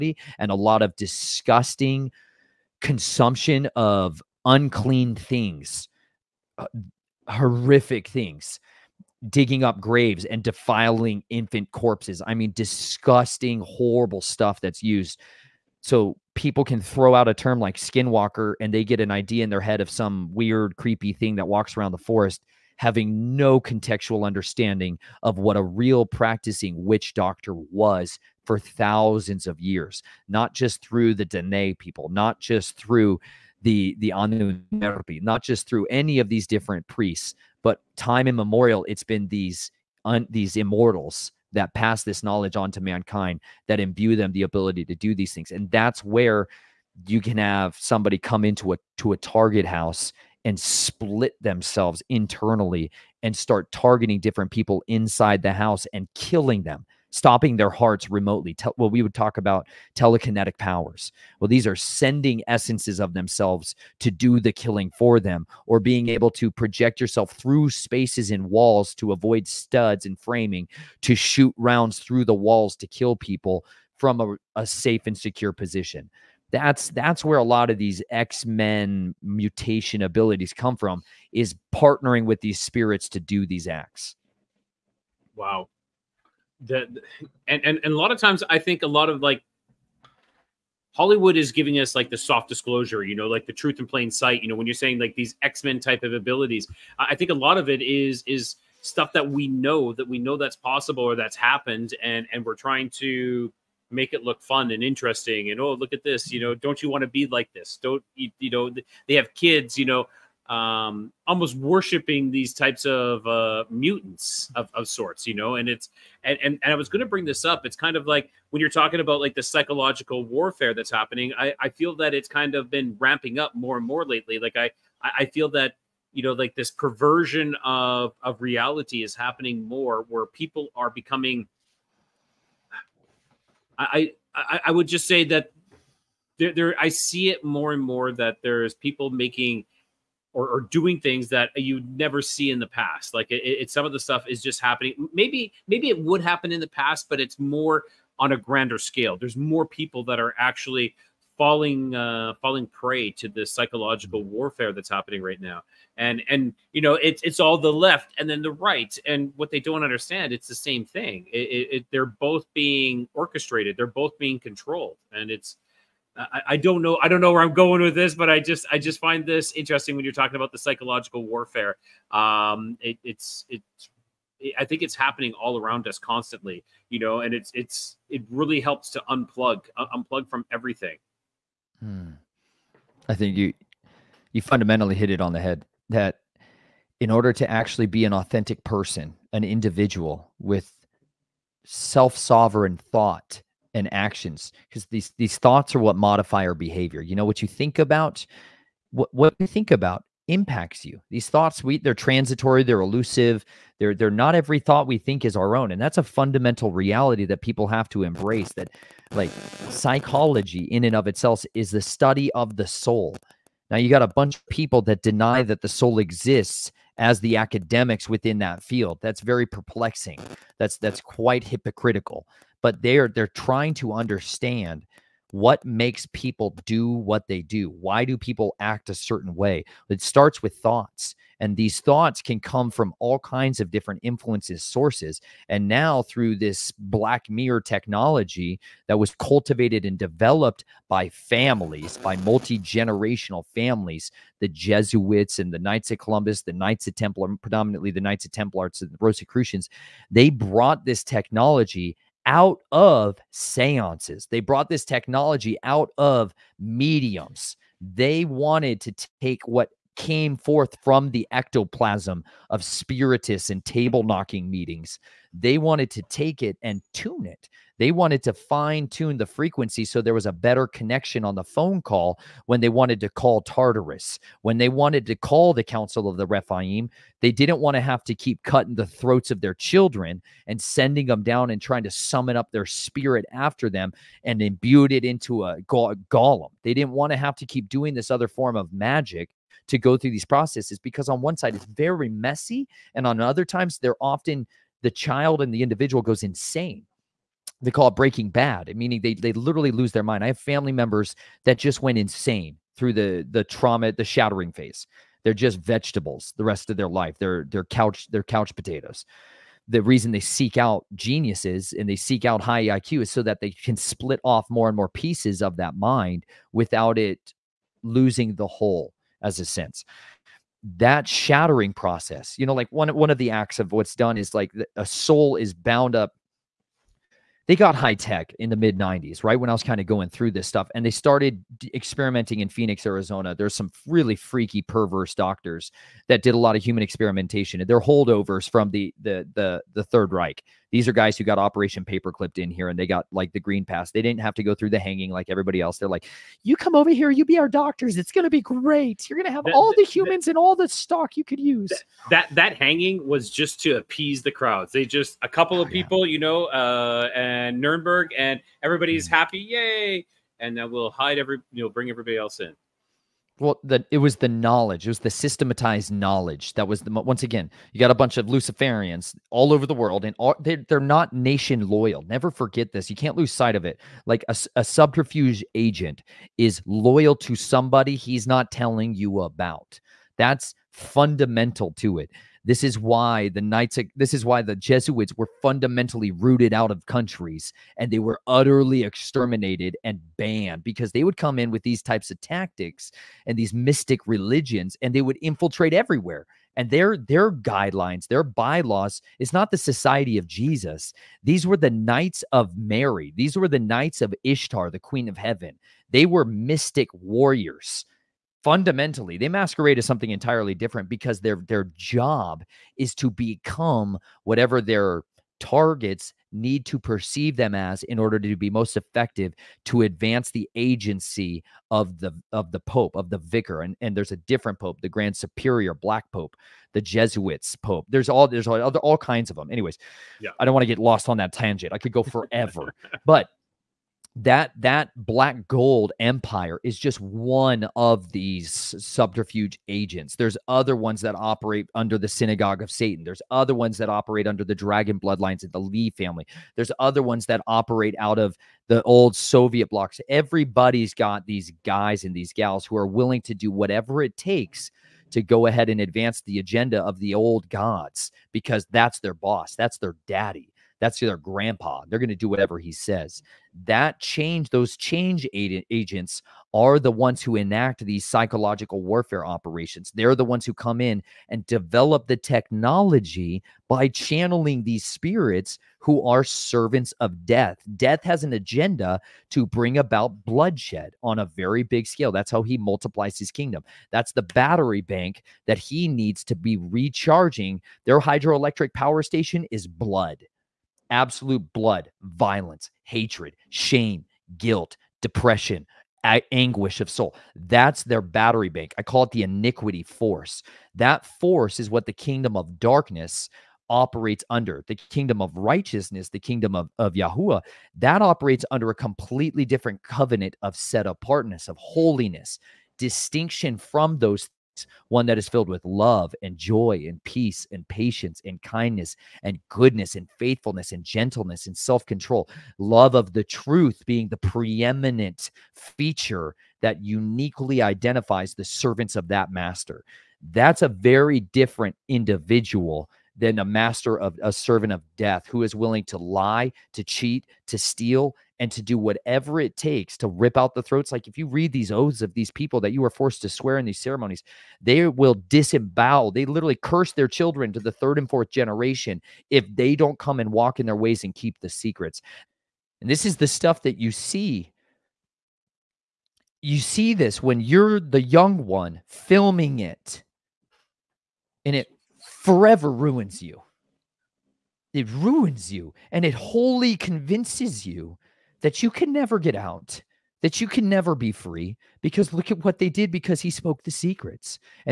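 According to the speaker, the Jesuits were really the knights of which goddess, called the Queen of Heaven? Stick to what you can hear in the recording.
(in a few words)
Ishtar.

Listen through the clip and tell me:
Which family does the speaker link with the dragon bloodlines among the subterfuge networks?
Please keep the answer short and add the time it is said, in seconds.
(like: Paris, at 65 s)
Lee family, at 445 s.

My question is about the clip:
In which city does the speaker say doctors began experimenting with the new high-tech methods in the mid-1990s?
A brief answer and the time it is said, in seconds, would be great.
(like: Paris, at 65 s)
Phoenix, at 332 s.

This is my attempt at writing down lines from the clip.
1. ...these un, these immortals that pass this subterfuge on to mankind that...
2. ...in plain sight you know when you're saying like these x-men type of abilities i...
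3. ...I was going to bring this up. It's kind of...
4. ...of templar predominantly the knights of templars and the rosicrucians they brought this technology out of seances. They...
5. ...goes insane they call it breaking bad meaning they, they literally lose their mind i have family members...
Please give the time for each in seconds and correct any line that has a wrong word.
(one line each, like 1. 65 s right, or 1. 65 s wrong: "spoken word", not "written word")
1. 39 s wrong: "knowledge", not "subterfuge"
2. 93 s right
3. 116 s right
4. 246 s right
5. 296 s right.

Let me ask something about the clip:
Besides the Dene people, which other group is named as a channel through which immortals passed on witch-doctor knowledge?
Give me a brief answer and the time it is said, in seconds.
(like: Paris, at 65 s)
Anunnaki, at 34 s.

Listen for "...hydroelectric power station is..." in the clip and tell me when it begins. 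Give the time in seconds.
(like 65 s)
488 s.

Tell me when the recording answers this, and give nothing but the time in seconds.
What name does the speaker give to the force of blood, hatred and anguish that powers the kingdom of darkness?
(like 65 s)
499 s.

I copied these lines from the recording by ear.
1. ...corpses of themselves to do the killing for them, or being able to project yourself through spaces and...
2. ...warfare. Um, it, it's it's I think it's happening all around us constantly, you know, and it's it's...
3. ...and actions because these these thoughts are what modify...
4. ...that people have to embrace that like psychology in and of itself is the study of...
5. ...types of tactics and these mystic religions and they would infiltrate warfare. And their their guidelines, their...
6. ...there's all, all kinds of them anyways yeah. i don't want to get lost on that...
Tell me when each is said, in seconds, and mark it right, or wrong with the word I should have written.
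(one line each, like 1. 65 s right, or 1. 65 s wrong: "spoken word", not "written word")
1. 62 s wrong: "essences", not "corpses"
2. 171 s right
3. 193 s right
4. 207 s right
5. 391 s wrong: "everywhere", not "warfare"
6. 428 s right.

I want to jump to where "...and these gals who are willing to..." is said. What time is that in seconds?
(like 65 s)
452 s.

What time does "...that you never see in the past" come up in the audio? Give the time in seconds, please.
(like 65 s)
141 s.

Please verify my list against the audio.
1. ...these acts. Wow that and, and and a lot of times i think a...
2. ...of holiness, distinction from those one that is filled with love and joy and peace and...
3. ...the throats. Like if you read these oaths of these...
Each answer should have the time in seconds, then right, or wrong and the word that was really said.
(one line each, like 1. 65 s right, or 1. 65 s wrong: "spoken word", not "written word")
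1. 83 s right
2. 511 s right
3. 540 s right.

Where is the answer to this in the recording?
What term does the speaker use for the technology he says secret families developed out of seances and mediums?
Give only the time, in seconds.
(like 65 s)
236 s.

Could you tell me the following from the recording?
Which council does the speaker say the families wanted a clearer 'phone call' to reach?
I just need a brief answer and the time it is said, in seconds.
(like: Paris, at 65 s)
Council of the Rephaim, at 275 s.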